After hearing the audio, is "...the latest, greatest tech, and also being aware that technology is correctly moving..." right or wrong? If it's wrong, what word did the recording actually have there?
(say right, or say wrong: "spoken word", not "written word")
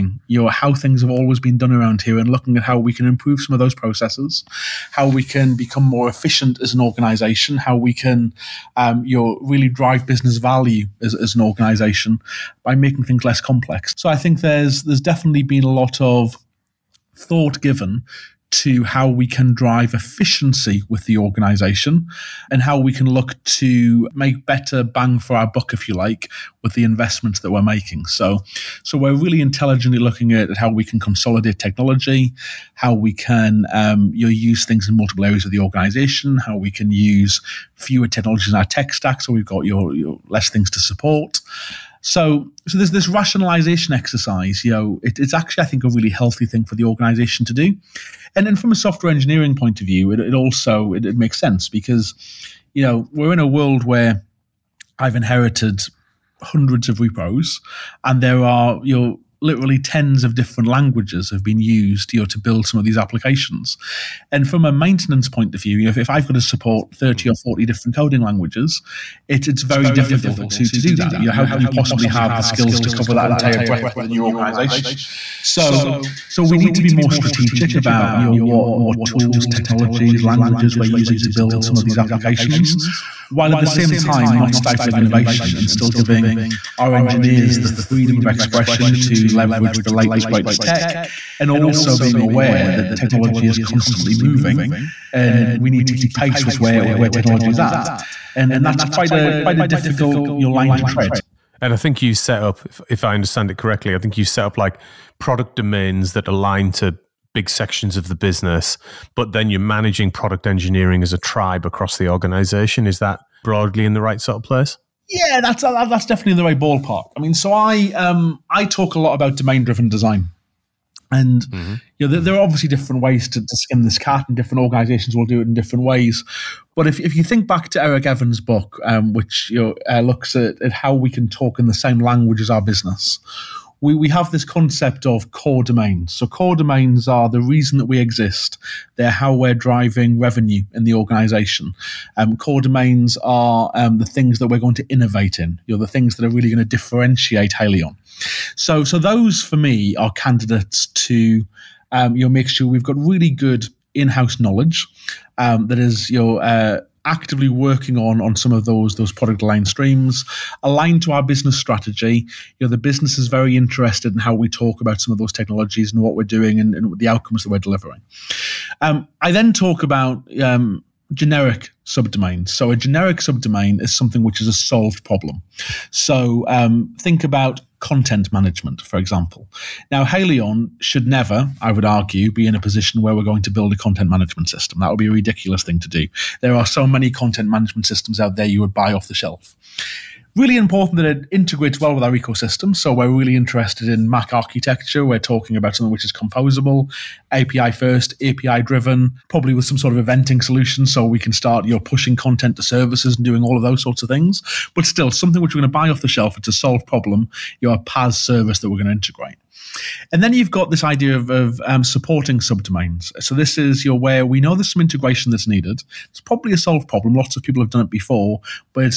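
wrong: "constantly", not "correctly".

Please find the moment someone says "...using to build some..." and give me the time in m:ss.
1:20.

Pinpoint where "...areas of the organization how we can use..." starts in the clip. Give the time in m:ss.
0:35.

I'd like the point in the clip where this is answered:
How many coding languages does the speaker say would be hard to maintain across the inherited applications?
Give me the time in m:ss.
1:06.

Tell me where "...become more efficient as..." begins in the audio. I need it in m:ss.
0:05.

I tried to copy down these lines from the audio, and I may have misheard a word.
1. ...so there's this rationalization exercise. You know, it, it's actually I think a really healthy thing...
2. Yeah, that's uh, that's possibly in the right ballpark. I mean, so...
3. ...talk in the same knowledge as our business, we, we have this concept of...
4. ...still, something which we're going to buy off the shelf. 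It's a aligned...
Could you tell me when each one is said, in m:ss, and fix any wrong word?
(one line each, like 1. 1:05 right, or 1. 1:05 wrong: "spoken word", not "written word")
1. 0:42 right
2. 1:55 wrong: "definitely", not "possibly"
3. 2:11 wrong: "language", not "knowledge"
4. 3:24 wrong: "solved", not "aligned".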